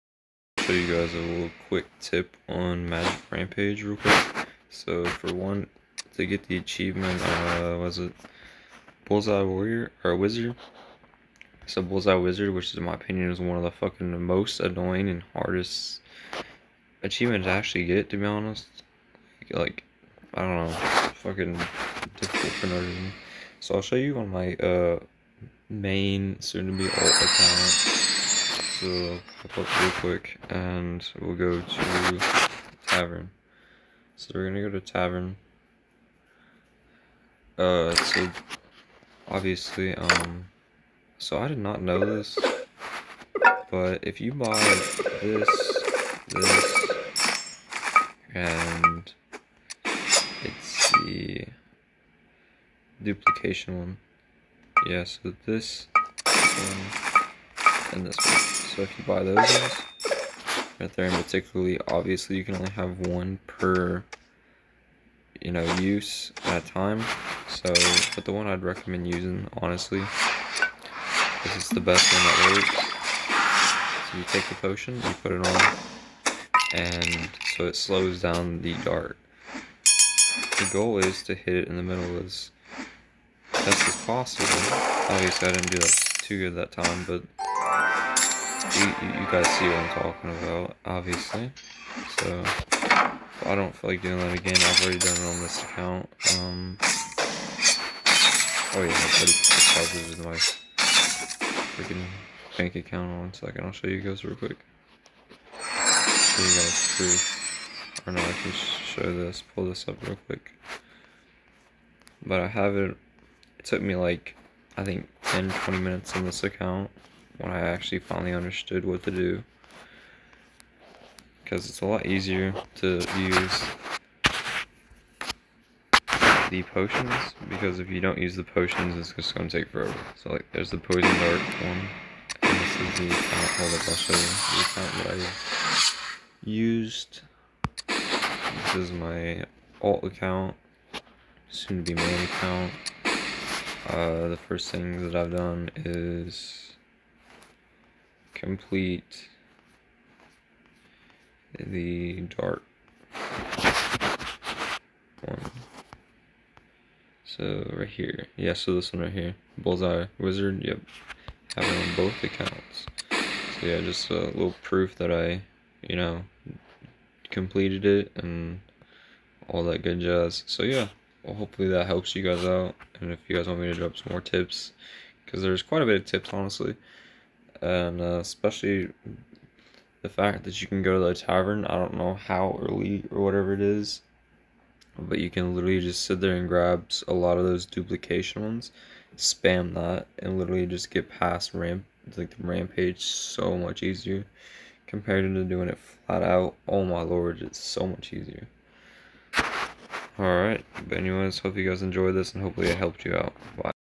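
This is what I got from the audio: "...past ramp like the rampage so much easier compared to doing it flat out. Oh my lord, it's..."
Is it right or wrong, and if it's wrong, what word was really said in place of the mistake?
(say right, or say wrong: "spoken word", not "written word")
right.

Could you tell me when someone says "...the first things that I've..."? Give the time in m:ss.
2:24.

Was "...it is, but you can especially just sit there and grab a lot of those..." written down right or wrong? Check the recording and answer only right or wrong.
wrong.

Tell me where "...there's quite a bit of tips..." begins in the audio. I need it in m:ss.
2:55.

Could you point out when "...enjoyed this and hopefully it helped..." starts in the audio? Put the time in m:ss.
3:21.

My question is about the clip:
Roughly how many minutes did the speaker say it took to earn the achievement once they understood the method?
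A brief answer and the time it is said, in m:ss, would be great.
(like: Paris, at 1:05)
10 to 20 minutes, at 1:55.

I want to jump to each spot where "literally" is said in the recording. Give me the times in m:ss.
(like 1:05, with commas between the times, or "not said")
3:05, 3:10.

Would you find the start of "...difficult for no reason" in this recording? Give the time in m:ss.
0:22.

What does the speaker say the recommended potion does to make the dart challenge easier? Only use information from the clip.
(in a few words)
Slows down the dart.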